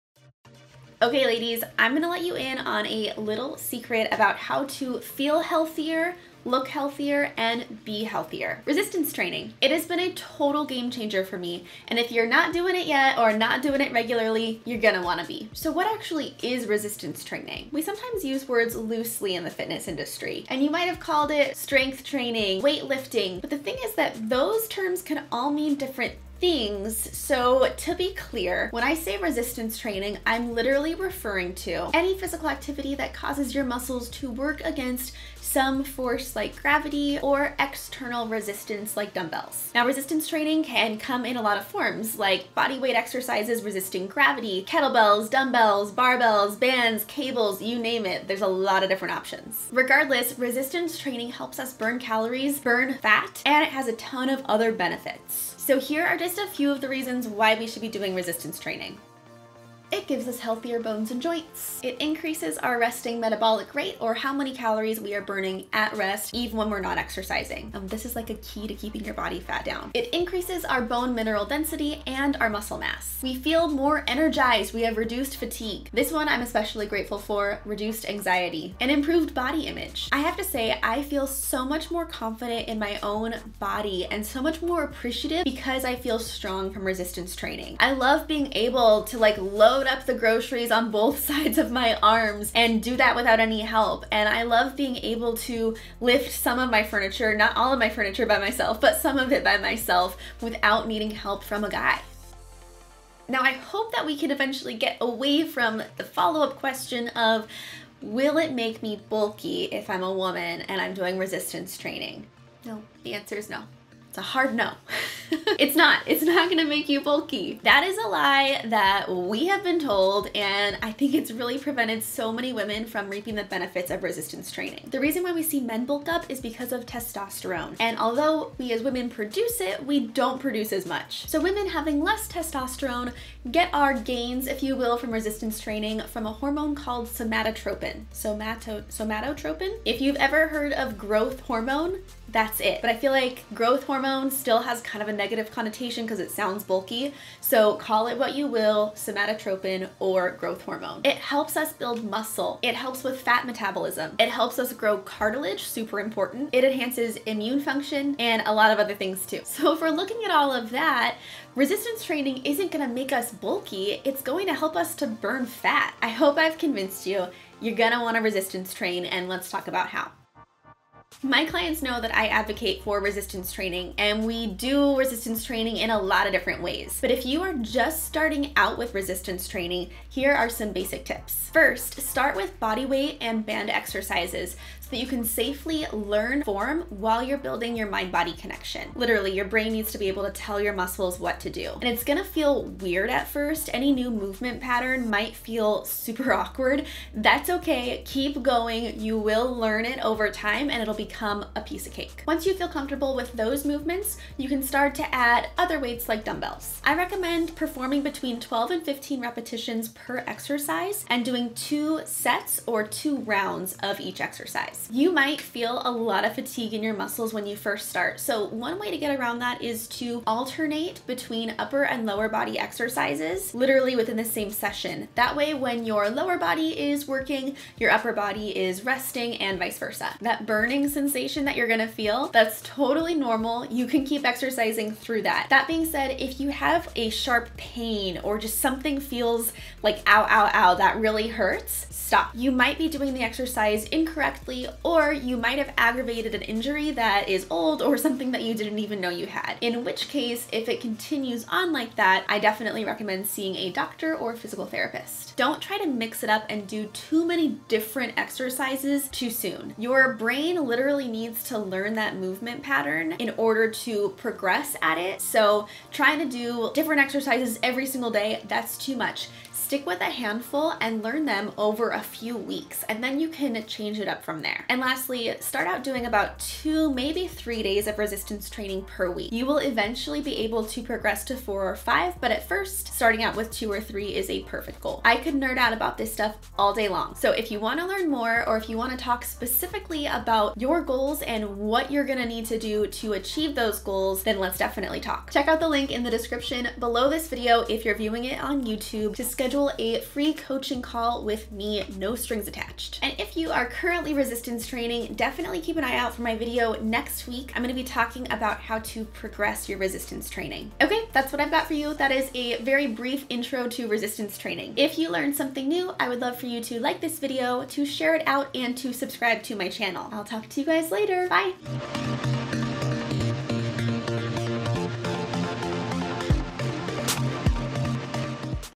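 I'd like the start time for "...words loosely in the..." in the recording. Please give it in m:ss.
0:18.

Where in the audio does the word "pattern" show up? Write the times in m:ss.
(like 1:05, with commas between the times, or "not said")
3:14, 4:22.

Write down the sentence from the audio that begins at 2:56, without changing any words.
But if you are just starting out with resistance training, here are some basic tips.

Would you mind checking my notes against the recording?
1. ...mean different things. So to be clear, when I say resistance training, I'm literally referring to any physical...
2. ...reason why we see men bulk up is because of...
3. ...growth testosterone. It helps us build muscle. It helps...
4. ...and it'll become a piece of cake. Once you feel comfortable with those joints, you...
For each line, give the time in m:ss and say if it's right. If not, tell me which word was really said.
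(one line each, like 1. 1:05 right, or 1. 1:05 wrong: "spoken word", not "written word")
1. 0:25 right
2. 2:04 right
3. 2:30 wrong: "hormone", not "testosterone"
4. 3:20 wrong: "movements", not "joints".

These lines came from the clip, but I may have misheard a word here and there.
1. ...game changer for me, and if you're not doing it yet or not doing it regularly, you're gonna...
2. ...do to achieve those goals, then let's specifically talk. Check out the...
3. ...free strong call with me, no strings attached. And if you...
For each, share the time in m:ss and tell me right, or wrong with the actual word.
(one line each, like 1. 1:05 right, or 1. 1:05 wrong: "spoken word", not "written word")
1. 0:10 right
2. 4:52 wrong: "definitely", not "specifically"
3. 5:00 wrong: "coaching", not "strong".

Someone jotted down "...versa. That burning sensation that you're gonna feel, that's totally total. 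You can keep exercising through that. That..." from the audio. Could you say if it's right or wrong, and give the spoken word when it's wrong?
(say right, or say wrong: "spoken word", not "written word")
wrong: "normal", not "total".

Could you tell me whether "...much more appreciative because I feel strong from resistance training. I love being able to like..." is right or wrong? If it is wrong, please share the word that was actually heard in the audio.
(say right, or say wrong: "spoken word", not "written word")
right.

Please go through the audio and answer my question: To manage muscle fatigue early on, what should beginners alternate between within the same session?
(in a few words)
upper and lower body.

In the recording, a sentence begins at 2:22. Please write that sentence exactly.
But I feel like growth hormone still has kind of a negative connotation because it sounds bulky.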